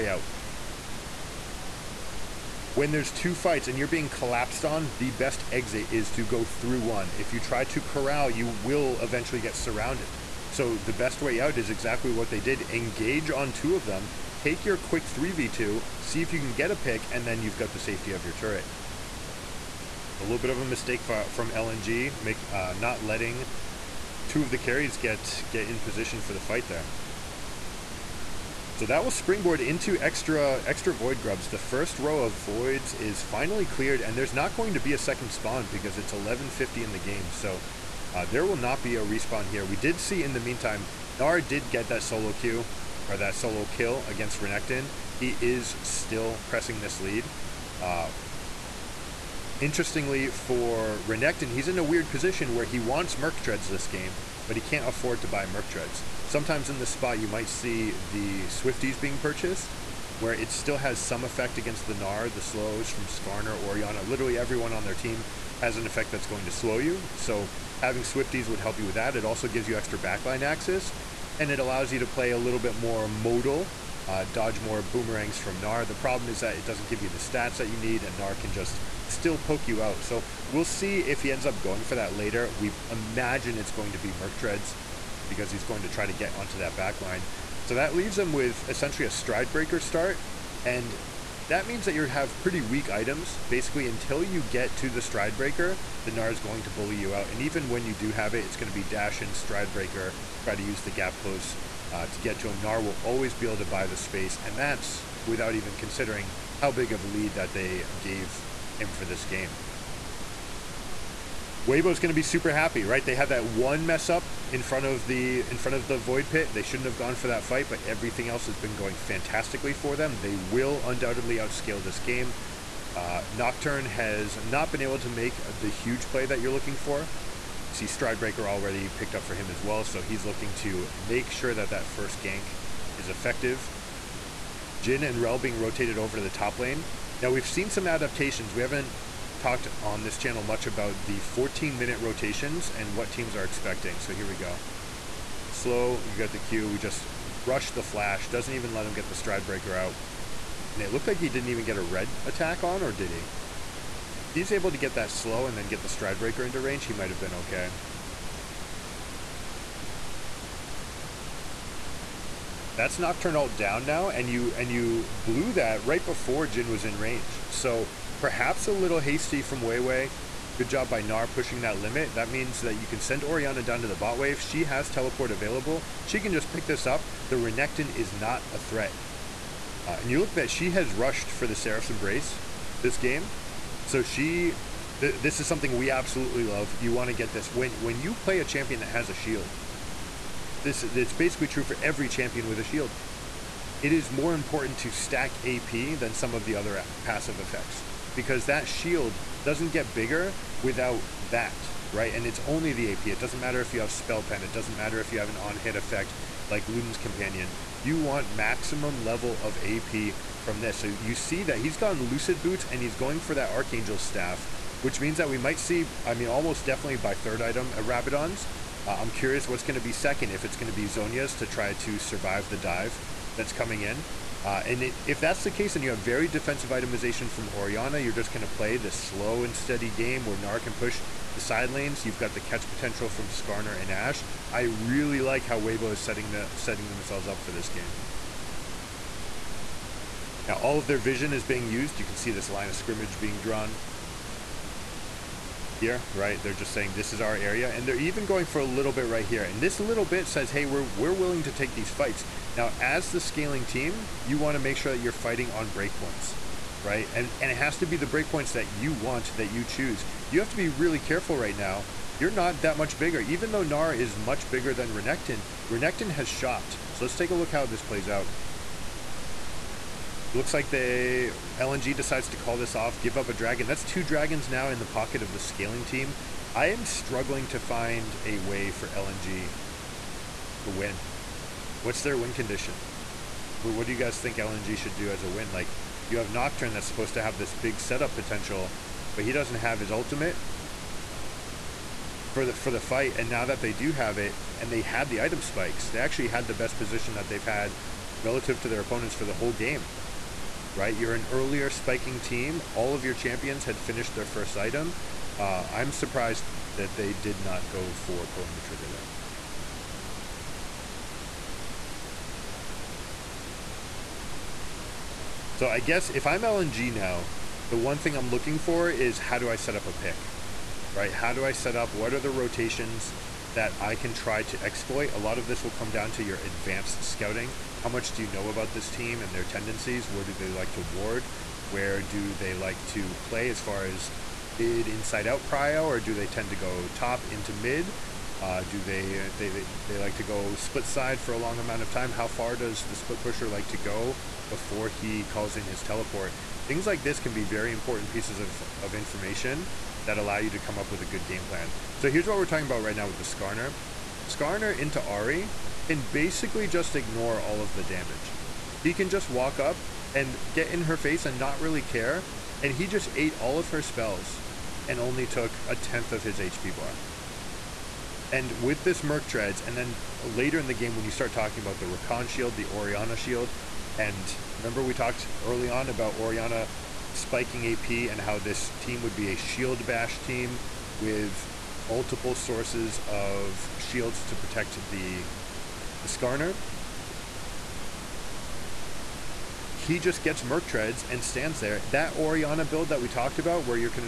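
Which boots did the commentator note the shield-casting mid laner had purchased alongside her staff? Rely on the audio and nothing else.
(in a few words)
Lucid Boots.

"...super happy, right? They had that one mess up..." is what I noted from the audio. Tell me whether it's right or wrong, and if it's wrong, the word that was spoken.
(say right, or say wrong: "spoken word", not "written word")
right.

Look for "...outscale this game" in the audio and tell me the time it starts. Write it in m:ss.
2:01.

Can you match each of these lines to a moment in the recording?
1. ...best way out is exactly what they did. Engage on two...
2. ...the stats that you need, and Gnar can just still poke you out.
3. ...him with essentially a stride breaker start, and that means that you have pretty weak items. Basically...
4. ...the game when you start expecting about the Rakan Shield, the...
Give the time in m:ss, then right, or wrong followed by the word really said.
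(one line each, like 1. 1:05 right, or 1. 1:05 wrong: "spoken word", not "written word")
1. 0:10 right
2. 1:17 right
3. 1:28 right
4. 6:10 wrong: "talking", not "expecting".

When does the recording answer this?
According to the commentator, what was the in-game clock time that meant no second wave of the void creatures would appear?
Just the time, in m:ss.
0:36.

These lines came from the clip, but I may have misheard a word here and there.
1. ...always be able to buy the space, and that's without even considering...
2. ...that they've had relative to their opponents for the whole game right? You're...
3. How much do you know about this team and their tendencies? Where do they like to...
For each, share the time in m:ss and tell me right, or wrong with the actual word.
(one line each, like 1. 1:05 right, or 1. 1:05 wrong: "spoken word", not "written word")
1. 1:43 right
2. 4:57 right
3. 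5:27 right.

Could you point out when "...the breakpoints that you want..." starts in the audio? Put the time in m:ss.
4:17.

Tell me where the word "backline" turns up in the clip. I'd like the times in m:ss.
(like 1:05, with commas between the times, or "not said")
1:09, 1:26.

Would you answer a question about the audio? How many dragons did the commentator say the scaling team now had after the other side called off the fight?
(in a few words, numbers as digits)
2.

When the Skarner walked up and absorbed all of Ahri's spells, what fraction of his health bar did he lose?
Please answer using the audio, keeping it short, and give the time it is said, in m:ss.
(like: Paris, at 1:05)
a tenth, at 6:05.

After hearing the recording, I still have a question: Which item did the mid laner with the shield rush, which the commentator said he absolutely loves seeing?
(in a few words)
Seraph's Embrace.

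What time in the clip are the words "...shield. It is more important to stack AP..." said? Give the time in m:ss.
3:12.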